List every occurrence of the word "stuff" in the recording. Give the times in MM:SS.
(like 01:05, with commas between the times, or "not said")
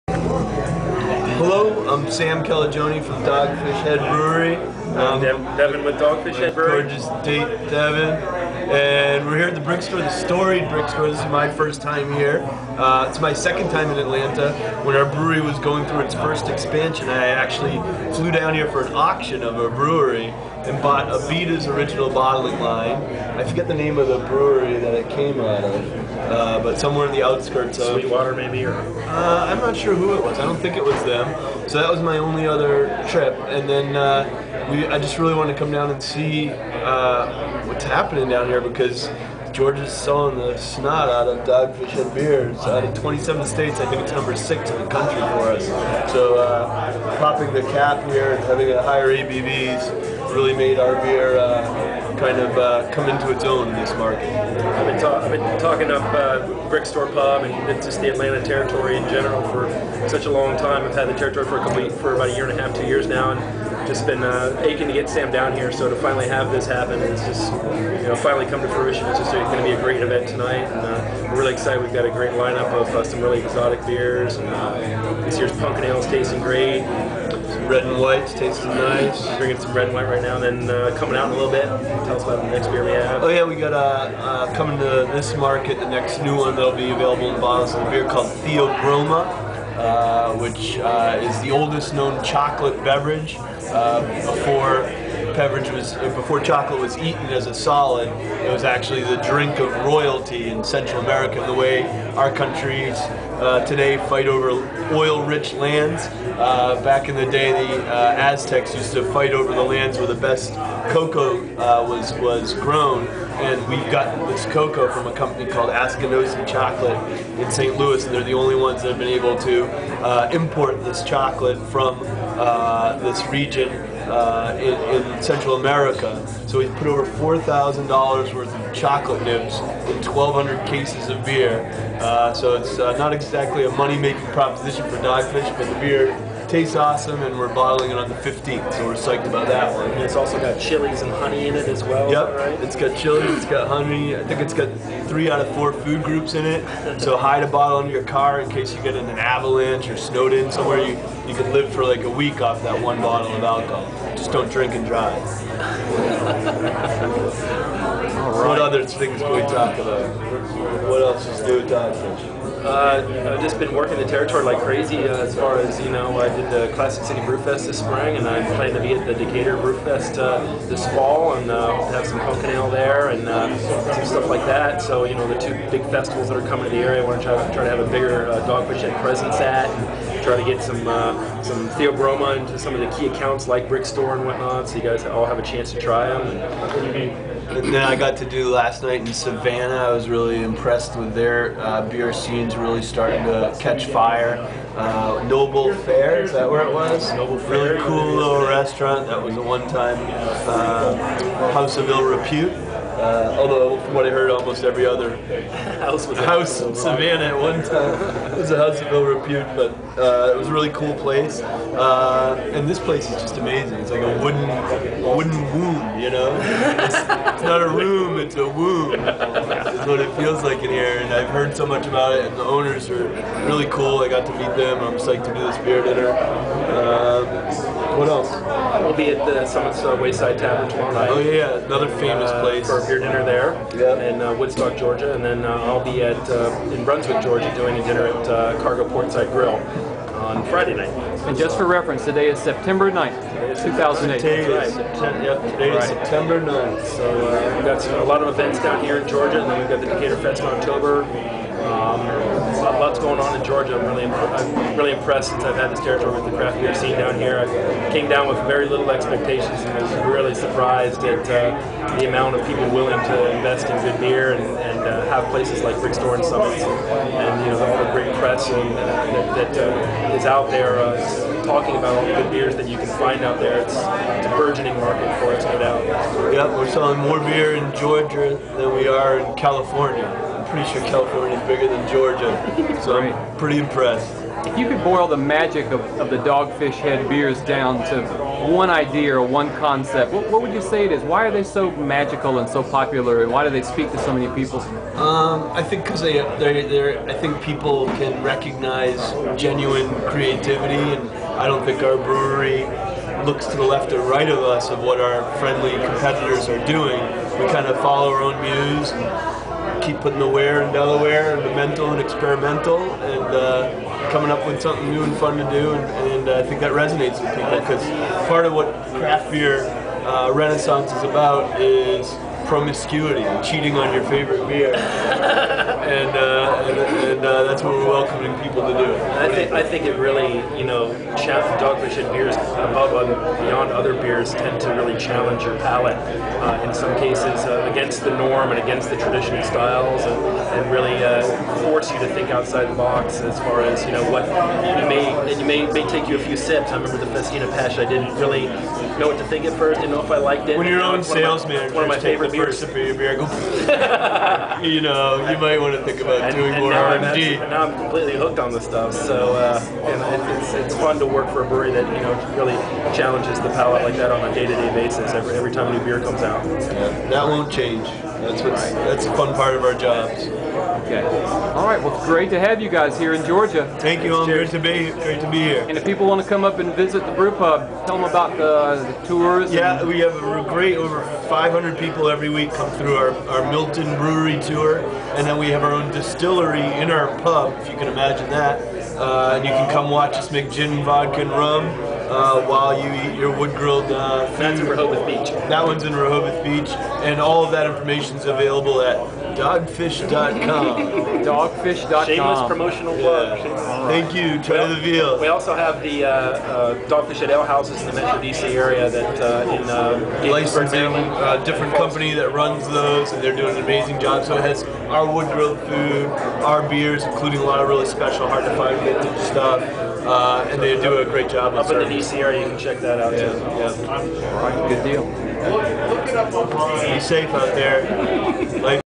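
02:54, 05:58, 06:59.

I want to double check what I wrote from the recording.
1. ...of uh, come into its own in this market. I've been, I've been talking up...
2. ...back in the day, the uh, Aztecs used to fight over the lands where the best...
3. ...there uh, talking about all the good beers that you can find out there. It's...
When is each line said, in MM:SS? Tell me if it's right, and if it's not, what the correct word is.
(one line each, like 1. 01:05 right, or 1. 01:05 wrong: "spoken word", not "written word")
1. 00:52 right
2. 01:46 right
3. 04:30 right.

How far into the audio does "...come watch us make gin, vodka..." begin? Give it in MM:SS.
06:29.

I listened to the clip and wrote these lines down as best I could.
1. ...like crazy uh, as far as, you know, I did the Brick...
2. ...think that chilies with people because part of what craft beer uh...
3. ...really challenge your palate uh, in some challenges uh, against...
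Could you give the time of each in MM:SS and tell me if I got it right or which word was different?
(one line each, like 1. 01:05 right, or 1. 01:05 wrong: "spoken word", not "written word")
1. 02:44 wrong: "Classic", not "Brick"
2. 05:16 wrong: "resonates", not "chilies"
3. 05:34 wrong: "cases", not "challenges".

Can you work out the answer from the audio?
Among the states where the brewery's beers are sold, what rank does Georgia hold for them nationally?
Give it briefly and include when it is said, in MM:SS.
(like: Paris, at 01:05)
number 6, at 00:44.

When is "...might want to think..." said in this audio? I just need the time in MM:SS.
05:55.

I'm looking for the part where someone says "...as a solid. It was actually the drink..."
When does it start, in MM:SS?
01:37.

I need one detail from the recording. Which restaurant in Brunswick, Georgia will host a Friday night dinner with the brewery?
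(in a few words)
Cargo Portside Grill.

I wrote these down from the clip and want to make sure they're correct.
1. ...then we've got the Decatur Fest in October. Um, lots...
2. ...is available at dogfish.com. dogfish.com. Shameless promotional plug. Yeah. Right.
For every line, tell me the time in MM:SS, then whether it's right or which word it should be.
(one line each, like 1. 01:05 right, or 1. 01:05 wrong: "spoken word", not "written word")
1. 04:09 right
2. 06:38 right.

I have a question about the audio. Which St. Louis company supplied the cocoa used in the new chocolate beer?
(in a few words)
Askinosie Chocolate.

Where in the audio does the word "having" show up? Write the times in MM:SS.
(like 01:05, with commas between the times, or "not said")
00:48.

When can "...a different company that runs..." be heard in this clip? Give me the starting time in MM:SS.
06:51.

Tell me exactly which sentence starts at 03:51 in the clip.
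Oh yeah, another uh, famous uh, place.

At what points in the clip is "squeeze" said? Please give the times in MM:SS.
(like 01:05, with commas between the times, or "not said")
not said.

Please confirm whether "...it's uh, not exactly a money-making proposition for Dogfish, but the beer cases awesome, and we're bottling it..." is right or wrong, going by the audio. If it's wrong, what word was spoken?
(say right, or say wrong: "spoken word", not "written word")
wrong: "tastes", not "cases".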